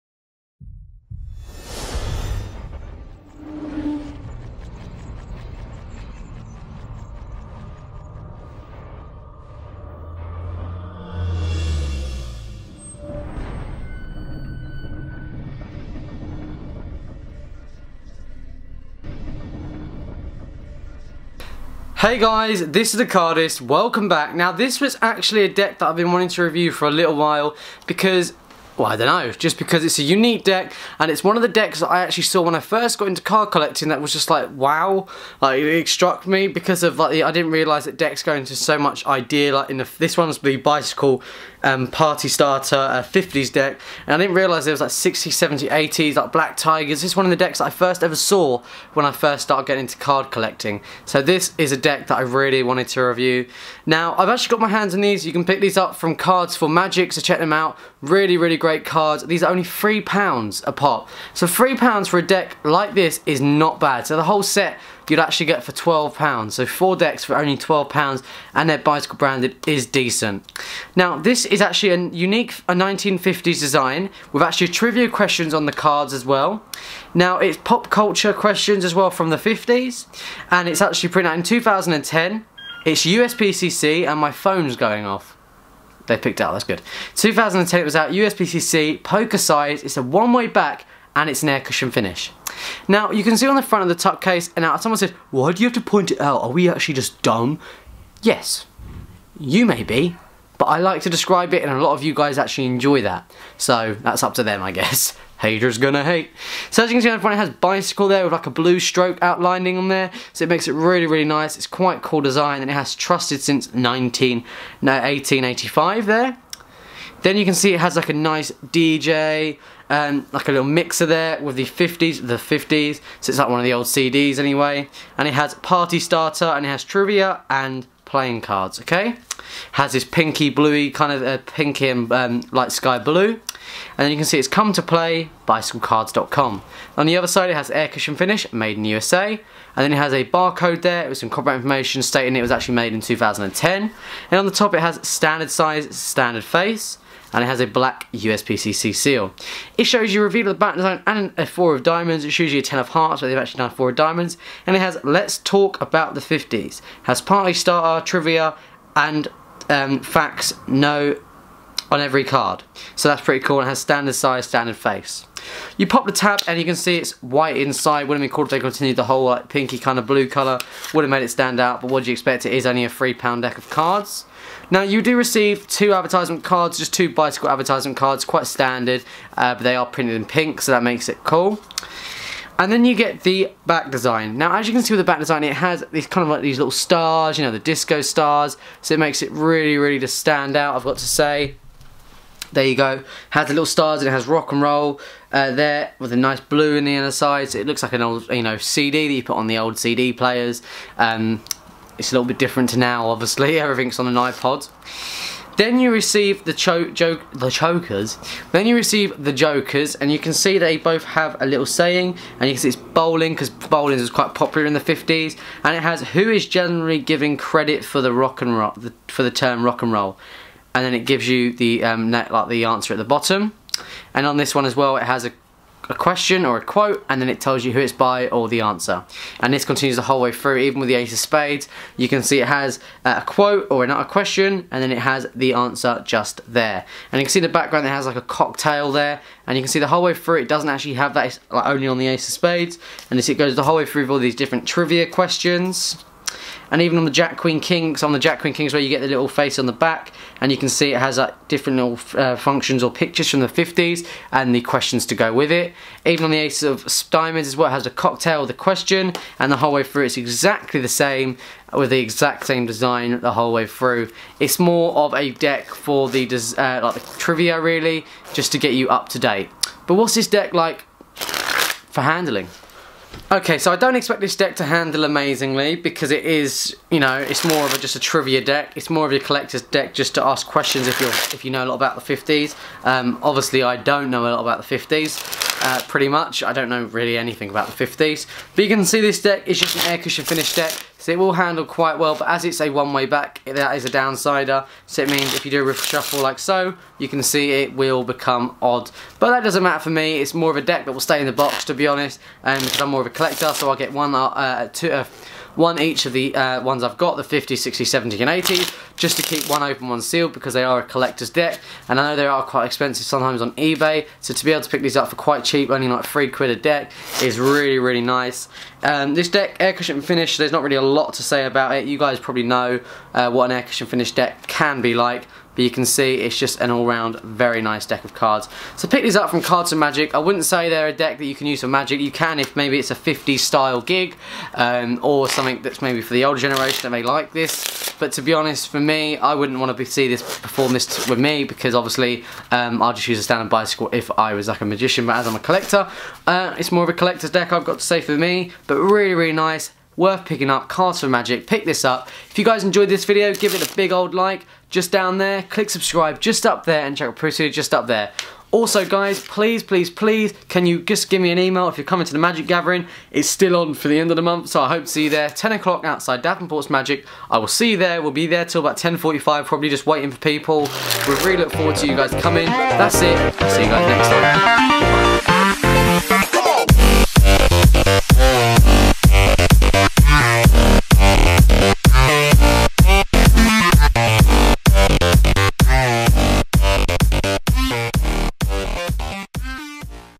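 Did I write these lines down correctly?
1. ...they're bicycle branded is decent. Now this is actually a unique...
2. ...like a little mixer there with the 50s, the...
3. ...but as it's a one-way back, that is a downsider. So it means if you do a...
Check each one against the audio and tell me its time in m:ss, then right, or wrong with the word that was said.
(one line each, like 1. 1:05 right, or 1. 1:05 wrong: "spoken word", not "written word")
1. 1:08 right
2. 2:00 right
3. 4:52 right.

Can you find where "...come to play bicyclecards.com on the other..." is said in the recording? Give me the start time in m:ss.
2:14.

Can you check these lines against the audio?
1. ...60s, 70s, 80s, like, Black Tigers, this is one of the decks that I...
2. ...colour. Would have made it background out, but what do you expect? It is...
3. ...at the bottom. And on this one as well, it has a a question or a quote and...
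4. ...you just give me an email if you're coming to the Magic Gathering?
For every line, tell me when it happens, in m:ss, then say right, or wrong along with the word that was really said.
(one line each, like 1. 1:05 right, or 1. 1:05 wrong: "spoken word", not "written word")
1. 0:44 right
2. 2:50 wrong: "stand", not "background"
3. 3:42 right
4. 6:00 right.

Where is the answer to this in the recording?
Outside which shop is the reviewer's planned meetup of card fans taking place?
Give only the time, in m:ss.
6:06.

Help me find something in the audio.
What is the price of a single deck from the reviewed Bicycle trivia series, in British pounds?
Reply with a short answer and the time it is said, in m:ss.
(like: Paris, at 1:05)
£3, at 0:59.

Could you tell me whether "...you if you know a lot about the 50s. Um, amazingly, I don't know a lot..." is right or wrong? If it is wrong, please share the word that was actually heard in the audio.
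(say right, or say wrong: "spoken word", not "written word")
wrong: "obviously", not "amazingly".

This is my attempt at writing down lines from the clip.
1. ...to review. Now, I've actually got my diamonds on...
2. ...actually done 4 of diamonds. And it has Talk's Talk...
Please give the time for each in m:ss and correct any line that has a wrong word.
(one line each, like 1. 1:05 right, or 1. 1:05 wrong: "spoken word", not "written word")
1. 0:52 wrong: "hands", not "diamonds"
2. 2:33 wrong: "Let", not "Talk".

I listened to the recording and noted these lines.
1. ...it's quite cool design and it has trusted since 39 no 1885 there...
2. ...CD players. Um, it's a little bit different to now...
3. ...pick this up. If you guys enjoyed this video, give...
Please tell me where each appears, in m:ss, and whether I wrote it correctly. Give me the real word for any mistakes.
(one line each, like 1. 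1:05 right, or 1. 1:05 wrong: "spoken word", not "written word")
1. 1:51 wrong: "19", not "39"
2. 3:19 right
3. 5:51 right.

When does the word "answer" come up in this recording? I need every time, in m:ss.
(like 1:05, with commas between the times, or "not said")
3:42, 3:48, 3:55.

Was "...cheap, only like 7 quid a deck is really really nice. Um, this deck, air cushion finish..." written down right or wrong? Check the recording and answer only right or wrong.
wrong.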